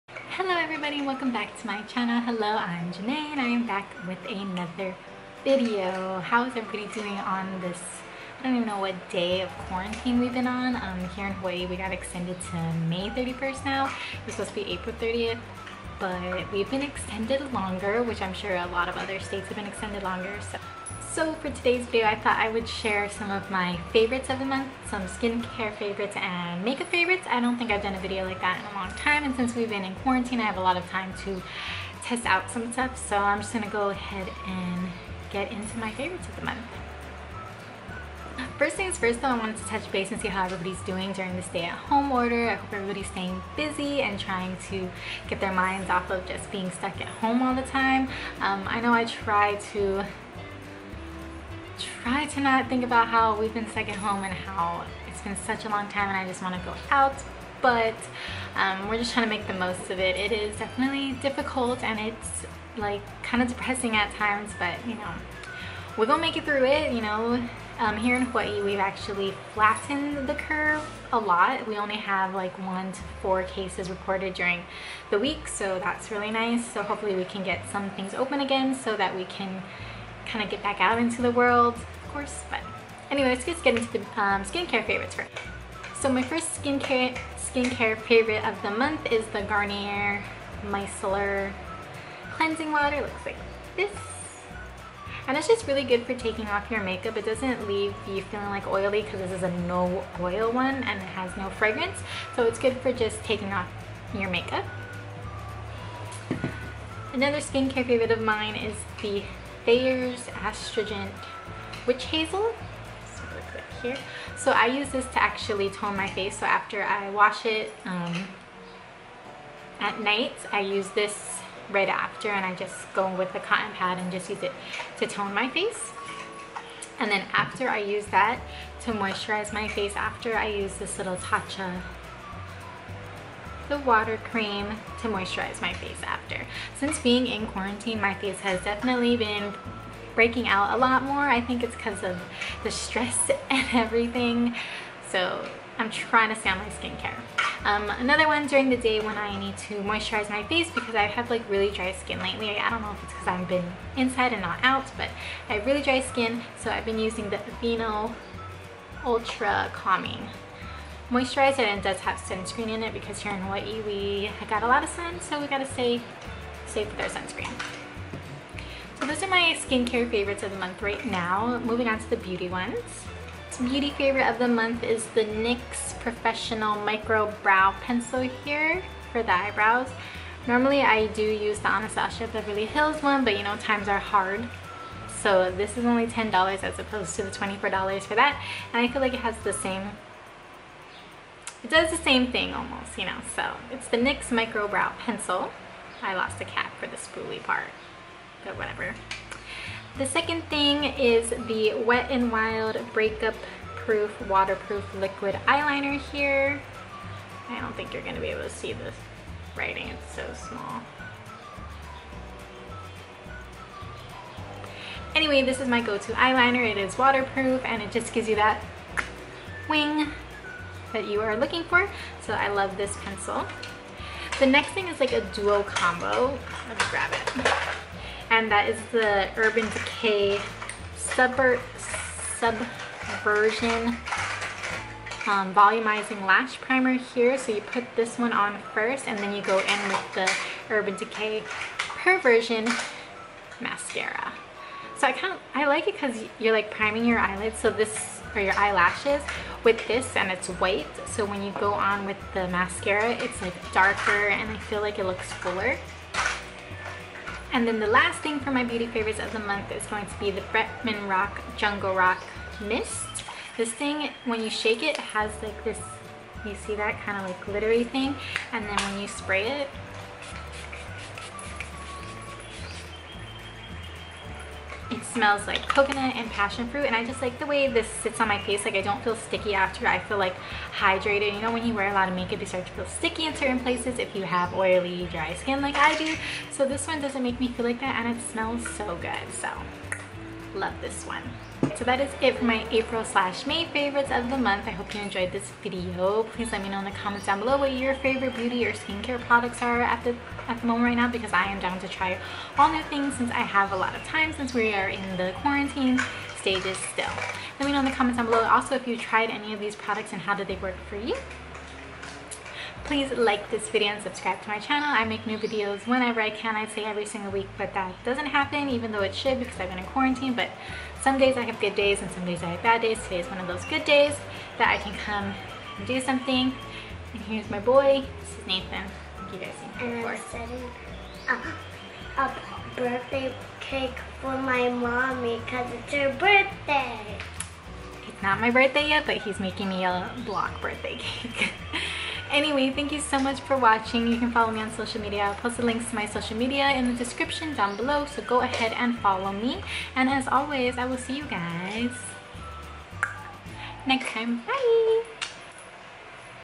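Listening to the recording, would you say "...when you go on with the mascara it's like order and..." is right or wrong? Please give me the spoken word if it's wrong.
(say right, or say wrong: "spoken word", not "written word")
wrong: "darker", not "order".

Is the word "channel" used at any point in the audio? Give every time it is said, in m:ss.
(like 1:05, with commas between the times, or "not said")
0:01, 5:14.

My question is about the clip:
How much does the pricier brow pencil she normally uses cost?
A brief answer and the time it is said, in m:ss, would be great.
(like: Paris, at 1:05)
$24, at 3:07.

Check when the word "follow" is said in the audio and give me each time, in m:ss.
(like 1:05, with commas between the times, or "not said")
5:44, 5:48.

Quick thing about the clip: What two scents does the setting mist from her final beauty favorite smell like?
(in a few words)
coconut and passion fruit.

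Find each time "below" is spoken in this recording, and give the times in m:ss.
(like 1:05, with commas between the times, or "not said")
4:57, 5:08, 5:47.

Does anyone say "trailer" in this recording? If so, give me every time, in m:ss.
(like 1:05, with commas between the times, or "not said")
not said.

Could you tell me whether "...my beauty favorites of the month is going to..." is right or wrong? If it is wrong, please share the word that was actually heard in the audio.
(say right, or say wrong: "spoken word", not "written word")
right.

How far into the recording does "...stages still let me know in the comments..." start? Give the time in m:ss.
5:06.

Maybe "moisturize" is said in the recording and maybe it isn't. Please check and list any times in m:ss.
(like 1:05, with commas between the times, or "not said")
2:08, 2:15, 2:29, 2:41.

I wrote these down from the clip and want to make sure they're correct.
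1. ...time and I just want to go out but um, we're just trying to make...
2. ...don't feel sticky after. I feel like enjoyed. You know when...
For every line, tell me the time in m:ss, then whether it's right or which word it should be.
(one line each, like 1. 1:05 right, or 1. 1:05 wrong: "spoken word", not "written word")
1. 0:55 right
2. 4:38 wrong: "hydrated", not "enjoyed".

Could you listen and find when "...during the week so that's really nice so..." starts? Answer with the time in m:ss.
1:14.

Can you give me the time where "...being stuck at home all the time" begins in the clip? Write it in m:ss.
0:46.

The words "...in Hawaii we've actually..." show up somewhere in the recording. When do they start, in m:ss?
1:08.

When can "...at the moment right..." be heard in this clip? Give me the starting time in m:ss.
5:00.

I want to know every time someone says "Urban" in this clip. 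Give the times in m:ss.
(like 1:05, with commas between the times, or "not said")
3:49, 4:00.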